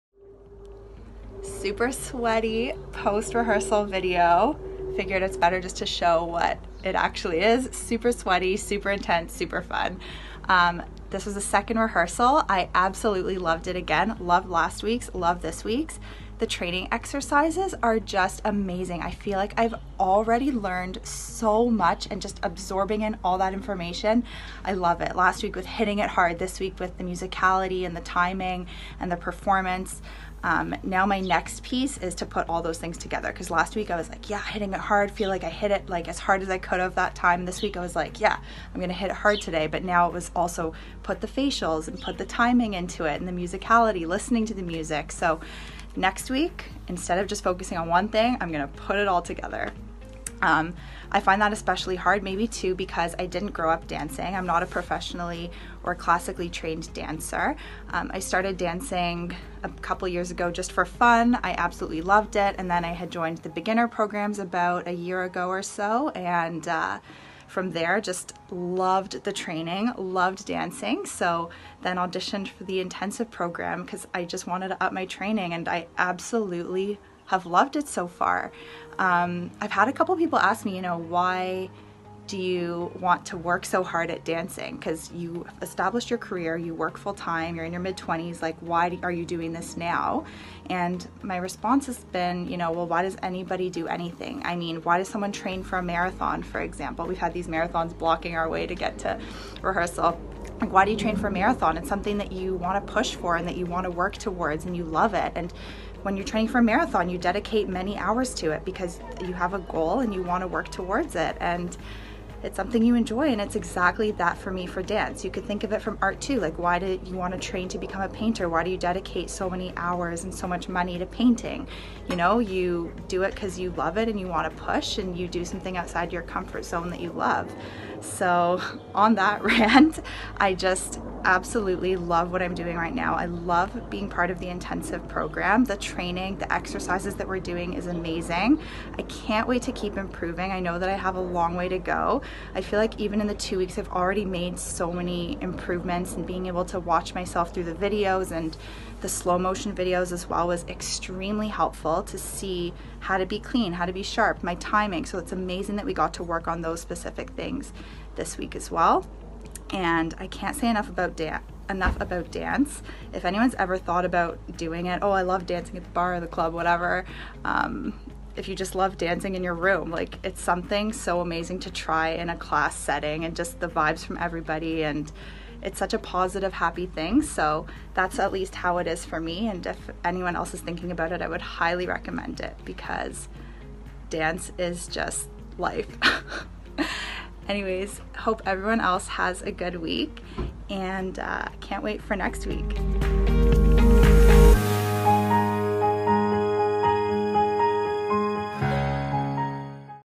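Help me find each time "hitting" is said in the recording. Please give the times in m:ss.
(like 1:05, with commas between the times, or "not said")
0:25, 0:34.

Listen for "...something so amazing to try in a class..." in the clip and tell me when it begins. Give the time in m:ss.
2:50.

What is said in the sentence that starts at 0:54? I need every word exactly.
I'm not a professionally or classically trained dancer.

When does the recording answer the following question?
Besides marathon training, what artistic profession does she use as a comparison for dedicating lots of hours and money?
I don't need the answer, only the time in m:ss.
1:58.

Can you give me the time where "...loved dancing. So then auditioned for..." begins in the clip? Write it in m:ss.
1:09.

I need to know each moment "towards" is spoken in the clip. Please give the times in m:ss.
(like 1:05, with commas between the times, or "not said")
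1:44, 1:50.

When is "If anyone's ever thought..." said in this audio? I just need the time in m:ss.
2:43.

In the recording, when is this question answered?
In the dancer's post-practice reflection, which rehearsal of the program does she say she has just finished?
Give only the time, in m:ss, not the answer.
0:11.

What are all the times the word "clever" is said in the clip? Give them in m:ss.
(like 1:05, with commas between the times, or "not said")
not said.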